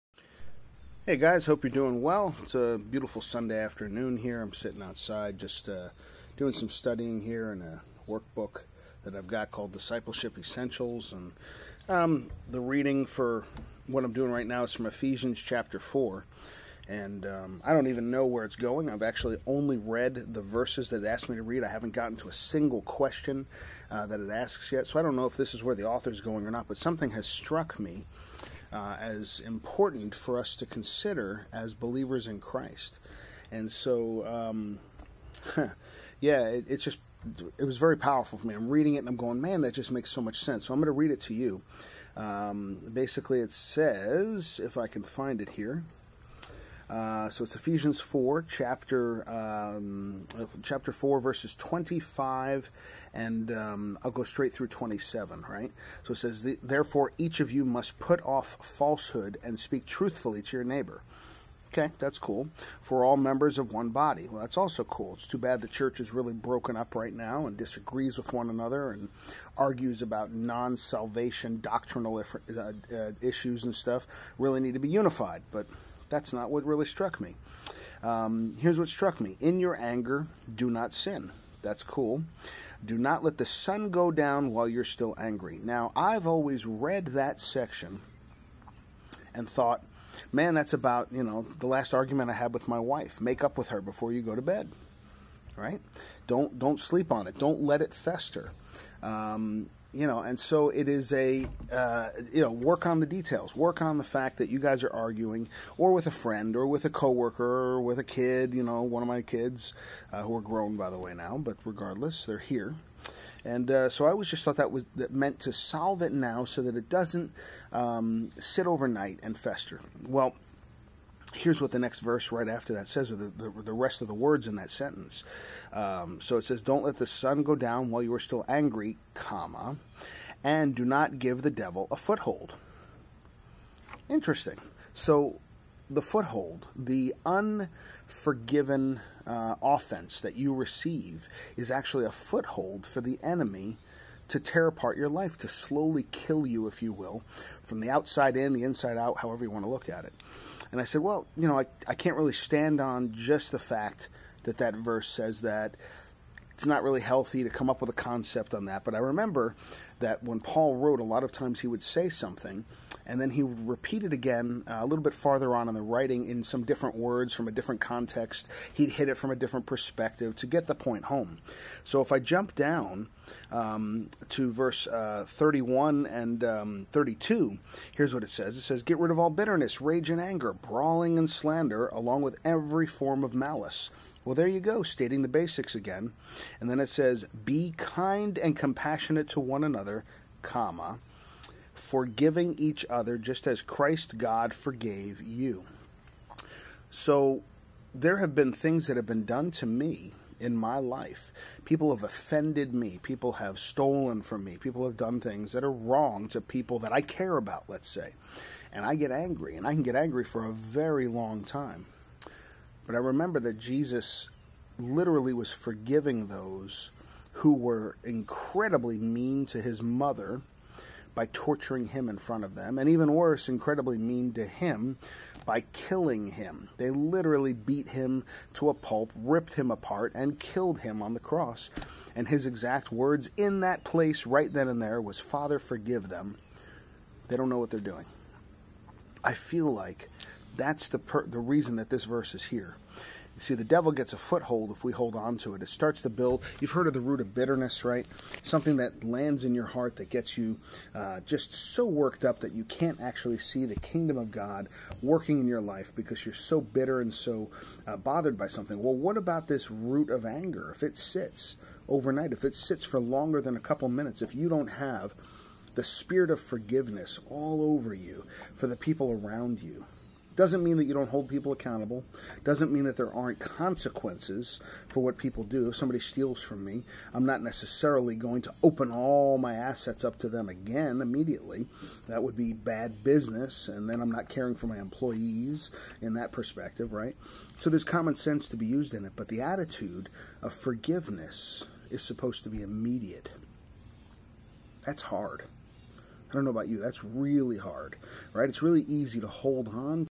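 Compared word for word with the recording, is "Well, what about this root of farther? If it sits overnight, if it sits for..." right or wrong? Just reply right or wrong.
wrong.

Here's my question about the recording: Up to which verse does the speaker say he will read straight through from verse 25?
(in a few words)
27.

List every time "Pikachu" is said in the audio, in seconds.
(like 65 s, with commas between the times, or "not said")
not said.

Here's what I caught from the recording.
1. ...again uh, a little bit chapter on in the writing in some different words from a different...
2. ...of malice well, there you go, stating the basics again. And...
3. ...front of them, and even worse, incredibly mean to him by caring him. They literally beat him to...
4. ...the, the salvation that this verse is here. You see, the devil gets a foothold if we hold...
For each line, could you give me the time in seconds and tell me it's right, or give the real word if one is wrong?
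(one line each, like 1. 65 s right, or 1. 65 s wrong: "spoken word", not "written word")
1. 164 s wrong: "farther", not "chapter"
2. 183 s right
3. 222 s wrong: "killing", not "caring"
4. 240 s wrong: "reason", not "salvation".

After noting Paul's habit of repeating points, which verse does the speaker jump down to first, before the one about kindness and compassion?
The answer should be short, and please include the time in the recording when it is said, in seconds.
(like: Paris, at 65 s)
31, at 175 s.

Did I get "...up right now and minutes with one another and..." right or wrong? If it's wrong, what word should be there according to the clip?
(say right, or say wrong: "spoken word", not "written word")
wrong: "disagrees", not "minutes".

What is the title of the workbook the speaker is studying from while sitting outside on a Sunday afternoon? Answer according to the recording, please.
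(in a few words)
Discipleship Essentials.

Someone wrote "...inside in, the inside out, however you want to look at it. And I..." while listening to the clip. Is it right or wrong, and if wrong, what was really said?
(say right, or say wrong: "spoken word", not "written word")
wrong: "outside", not "inside".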